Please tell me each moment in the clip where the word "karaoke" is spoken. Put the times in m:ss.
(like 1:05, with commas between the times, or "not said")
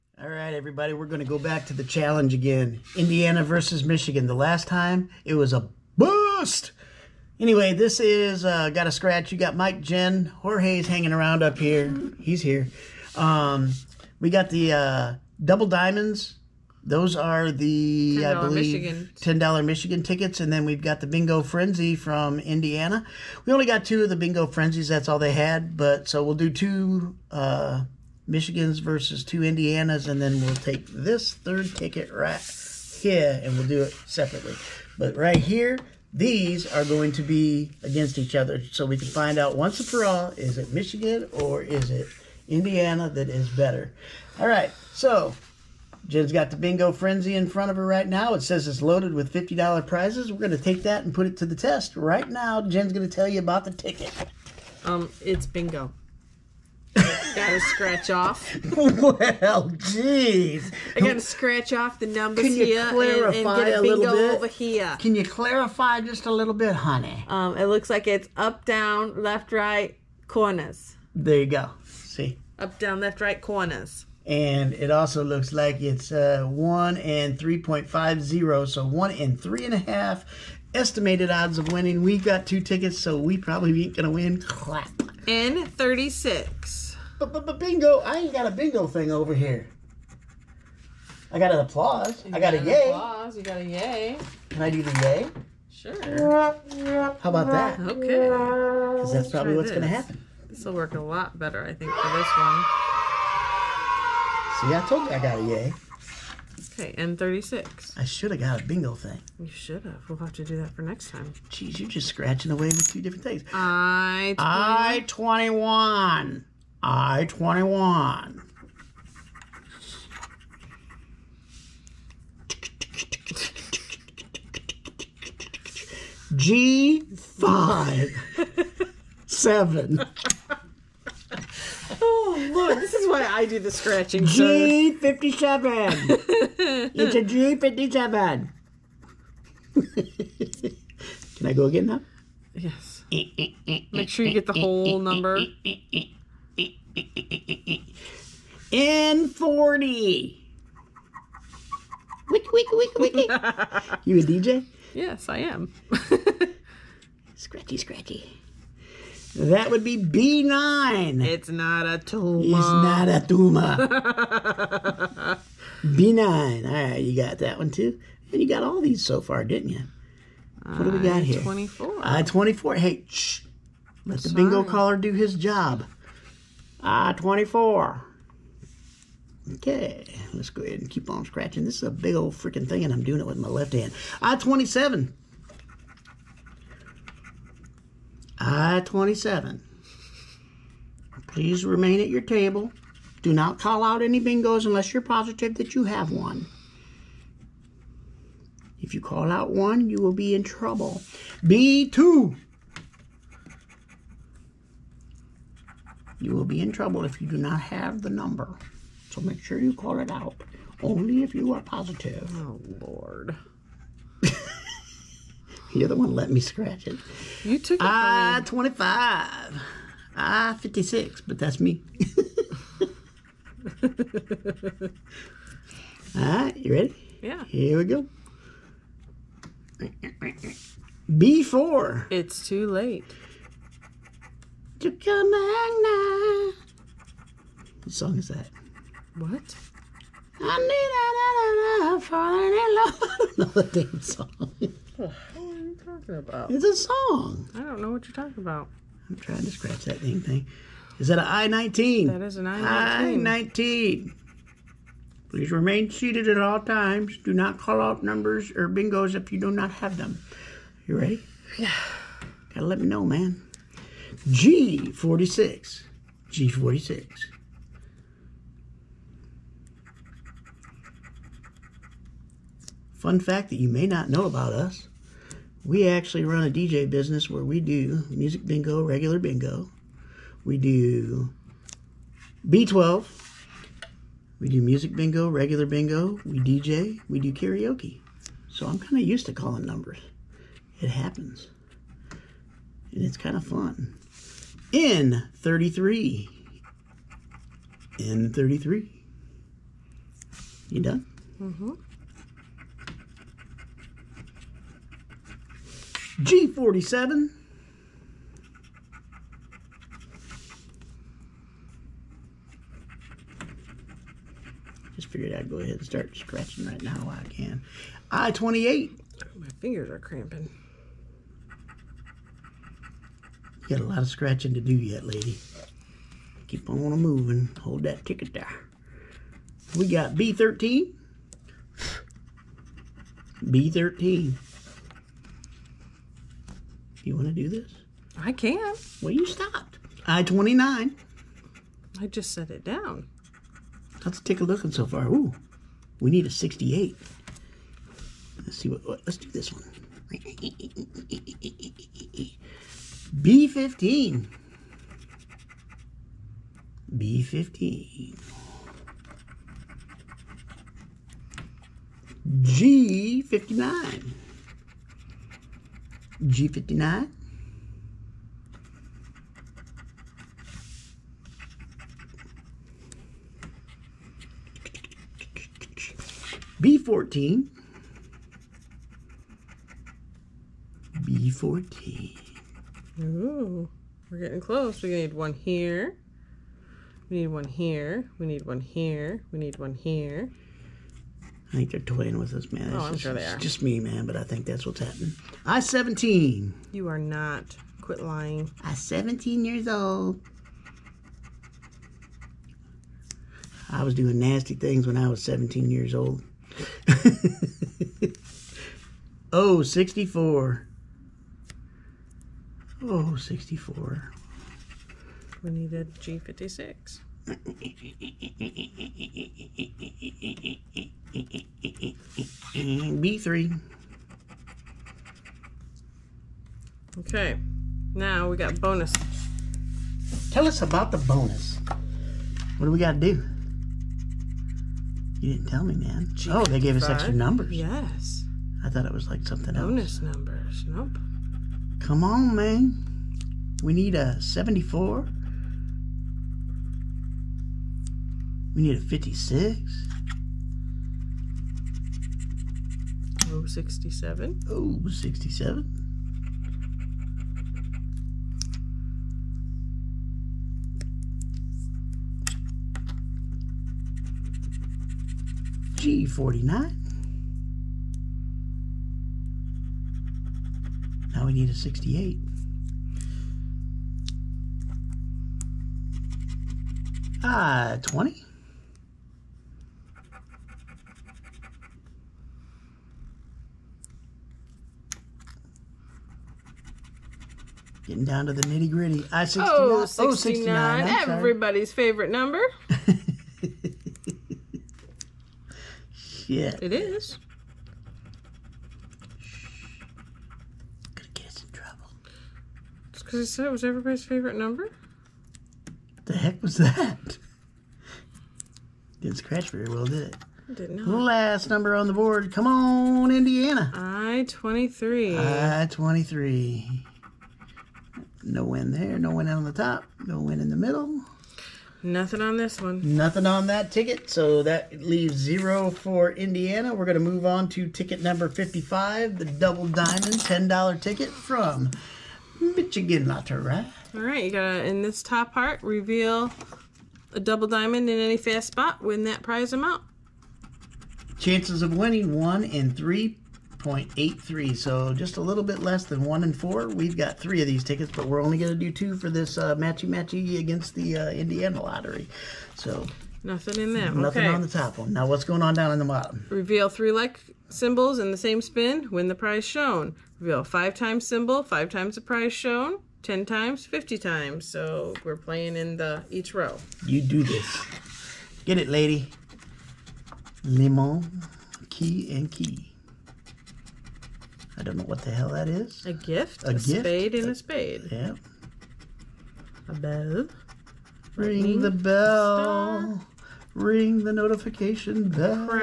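4:47.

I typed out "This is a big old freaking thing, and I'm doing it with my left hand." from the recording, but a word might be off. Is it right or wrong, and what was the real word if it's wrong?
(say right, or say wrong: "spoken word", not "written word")
right.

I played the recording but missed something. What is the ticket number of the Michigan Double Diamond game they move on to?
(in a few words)
55.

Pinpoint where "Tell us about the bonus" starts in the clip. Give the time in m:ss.
7:10.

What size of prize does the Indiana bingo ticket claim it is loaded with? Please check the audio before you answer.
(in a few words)
$50.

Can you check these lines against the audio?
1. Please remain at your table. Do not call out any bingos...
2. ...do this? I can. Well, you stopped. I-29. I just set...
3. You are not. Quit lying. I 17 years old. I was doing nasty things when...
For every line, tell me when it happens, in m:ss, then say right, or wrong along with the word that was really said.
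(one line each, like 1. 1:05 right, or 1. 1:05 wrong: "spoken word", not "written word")
1. 3:11 right
2. 5:37 right
3. 6:36 right.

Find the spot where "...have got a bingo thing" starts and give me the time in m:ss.
1:48.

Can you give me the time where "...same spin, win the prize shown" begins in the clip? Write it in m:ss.
9:18.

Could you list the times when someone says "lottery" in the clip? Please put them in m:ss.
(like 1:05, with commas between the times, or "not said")
8:53, 9:11.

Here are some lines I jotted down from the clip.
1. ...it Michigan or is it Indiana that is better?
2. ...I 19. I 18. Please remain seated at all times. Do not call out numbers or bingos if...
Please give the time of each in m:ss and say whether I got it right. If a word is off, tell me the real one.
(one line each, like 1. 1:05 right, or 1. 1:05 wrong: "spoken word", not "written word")
1. 0:40 right
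2. 4:12 wrong: "19", not "18".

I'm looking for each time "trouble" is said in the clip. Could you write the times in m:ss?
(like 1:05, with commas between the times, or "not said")
3:20, 3:26.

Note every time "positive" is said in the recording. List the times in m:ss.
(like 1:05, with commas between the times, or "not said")
3:15, 3:31.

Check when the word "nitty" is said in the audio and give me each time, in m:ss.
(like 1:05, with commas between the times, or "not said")
8:08.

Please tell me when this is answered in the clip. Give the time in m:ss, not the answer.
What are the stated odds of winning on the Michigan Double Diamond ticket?
9:02.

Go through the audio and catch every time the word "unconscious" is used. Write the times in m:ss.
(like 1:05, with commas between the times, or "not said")
not said.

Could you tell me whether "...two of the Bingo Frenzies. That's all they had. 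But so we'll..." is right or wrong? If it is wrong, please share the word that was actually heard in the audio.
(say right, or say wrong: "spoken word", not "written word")
right.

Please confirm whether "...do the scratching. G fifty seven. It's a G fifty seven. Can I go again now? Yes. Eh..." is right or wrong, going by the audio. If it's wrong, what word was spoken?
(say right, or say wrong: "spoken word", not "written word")
right.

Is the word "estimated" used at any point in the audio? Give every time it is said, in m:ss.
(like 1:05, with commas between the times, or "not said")
1:20.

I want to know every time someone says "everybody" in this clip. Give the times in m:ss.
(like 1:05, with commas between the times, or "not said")
0:00, 8:11, 8:23.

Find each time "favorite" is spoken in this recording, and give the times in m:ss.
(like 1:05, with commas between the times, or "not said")
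8:11, 8:24.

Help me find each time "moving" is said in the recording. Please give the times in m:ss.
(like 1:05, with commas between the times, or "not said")
5:26.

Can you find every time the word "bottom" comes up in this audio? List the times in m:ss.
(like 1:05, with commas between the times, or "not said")
9:15.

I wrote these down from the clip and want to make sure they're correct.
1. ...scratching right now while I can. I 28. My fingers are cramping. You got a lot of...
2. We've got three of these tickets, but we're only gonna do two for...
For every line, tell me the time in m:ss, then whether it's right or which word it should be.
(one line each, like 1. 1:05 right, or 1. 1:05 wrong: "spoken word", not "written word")
1. 5:16 right
2. 9:06 right.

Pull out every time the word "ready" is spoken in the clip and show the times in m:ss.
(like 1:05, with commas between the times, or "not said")
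3:46, 4:20.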